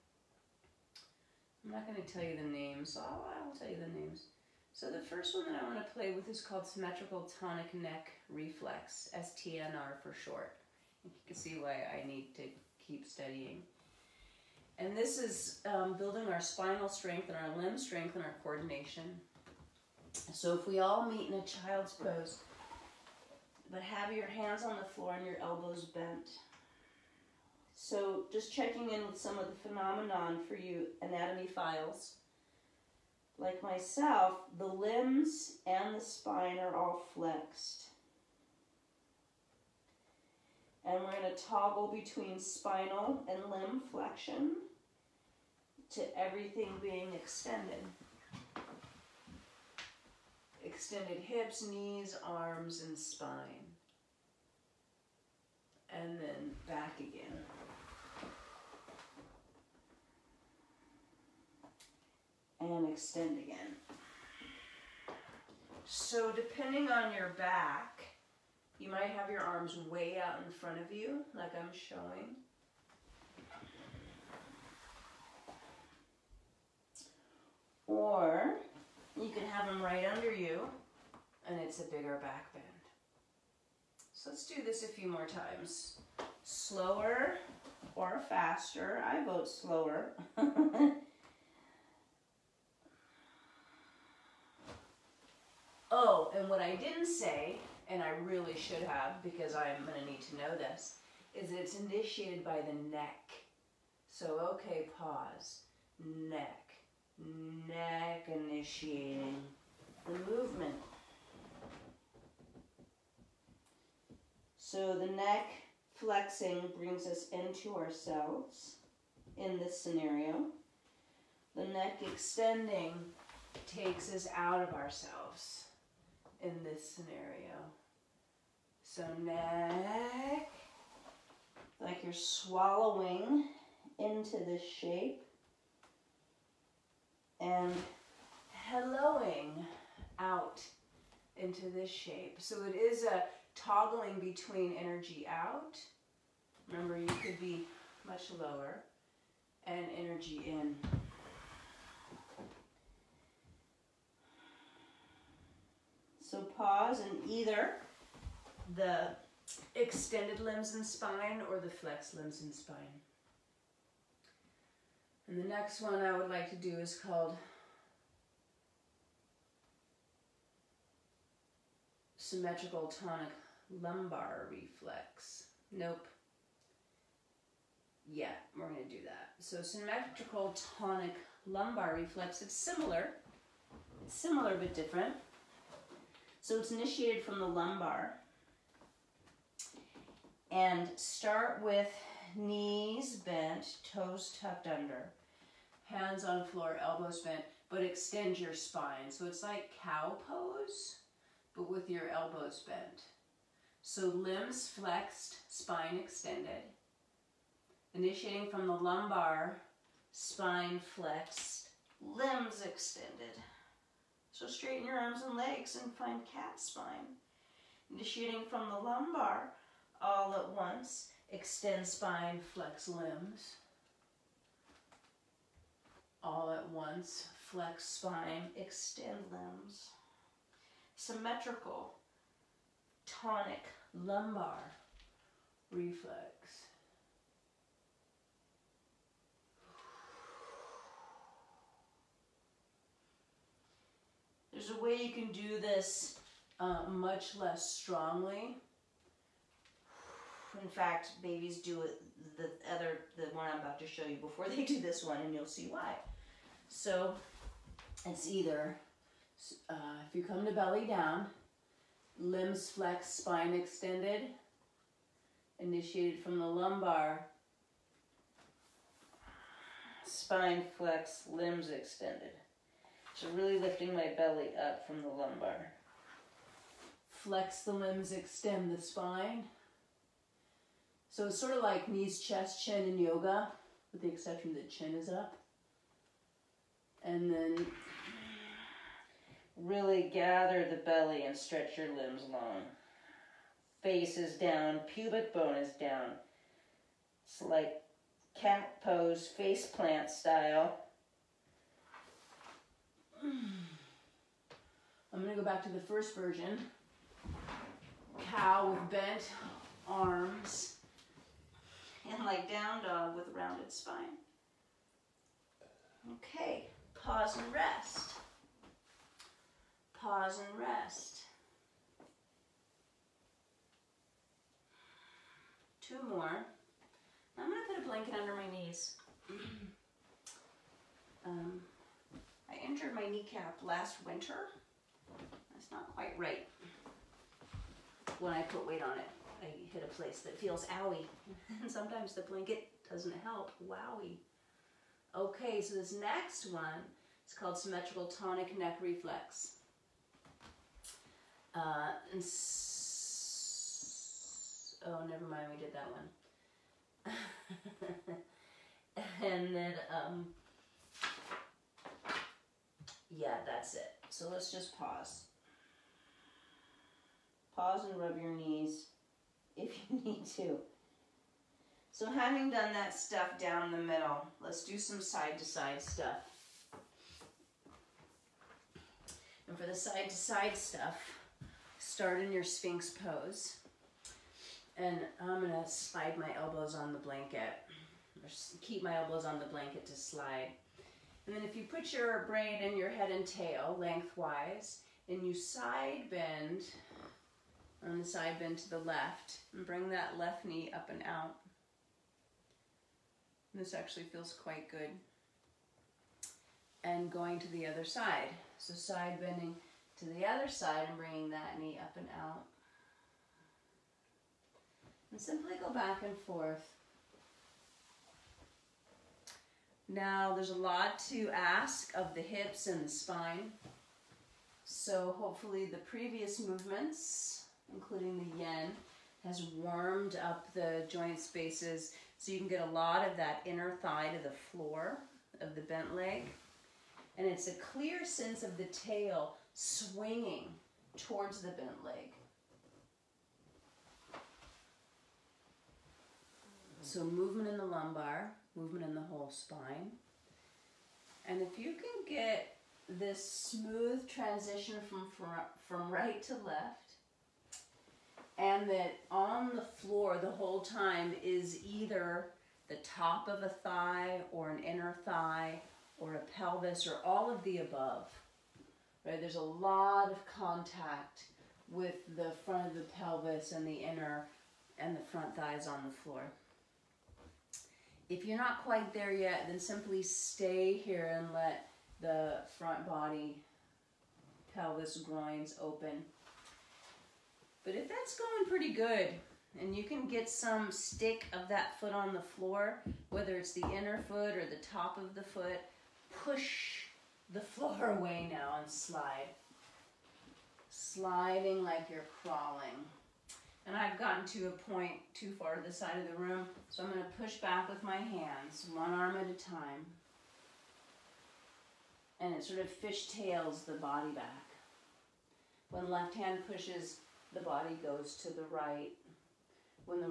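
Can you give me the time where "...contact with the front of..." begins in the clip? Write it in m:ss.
7:50.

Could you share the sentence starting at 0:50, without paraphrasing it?
Extended hips, knees, arms, and spine.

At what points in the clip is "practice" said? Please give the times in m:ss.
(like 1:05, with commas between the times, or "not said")
not said.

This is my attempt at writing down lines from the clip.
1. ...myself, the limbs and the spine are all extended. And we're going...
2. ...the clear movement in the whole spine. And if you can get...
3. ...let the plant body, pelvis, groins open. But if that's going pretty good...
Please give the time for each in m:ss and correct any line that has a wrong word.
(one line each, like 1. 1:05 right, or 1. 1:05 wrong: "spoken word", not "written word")
1. 0:33 wrong: "flexed", not "extended"
2. 7:27 wrong: "lumbar", not "clear"
3. 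8:01 wrong: "front", not "plant".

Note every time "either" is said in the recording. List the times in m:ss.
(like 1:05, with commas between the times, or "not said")
2:37, 4:18, 7:41.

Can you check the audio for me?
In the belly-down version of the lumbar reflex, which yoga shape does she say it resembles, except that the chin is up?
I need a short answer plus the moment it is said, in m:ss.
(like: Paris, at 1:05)
Knees, chest, chin, at 4:41.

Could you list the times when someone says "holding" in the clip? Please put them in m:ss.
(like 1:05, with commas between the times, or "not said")
not said.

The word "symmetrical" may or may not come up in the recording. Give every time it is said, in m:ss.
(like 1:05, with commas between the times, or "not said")
0:06, 2:52, 2:59, 3:50, 5:47.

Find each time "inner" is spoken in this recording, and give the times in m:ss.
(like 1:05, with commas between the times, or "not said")
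7:13, 7:44, 7:53, 8:13.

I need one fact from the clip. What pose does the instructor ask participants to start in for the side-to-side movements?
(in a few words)
Sphinx pose.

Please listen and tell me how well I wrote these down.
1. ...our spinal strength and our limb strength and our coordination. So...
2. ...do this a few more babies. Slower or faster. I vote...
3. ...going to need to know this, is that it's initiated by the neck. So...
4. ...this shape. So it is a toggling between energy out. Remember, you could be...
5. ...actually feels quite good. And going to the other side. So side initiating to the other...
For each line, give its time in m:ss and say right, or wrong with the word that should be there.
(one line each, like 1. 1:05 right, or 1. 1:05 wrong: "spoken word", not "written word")
1. 0:16 right
2. 1:24 wrong: "times", not "babies"
3. 1:39 right
4. 2:21 right
5. 6:43 wrong: "bending", not "initiating".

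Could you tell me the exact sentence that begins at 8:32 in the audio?
And it sort of fishtails the body back.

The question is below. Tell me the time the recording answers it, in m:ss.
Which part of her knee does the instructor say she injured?
5:33.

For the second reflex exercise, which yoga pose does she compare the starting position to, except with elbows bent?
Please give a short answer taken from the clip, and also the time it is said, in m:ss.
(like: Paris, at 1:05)
Cow pose, at 3:19.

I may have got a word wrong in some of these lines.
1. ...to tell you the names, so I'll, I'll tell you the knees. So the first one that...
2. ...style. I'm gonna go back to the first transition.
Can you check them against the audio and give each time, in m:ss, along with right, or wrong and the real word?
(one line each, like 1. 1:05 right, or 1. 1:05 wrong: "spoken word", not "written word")
1. 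0:02 wrong: "names", not "knees"
2. 5:00 wrong: "version", not "transition".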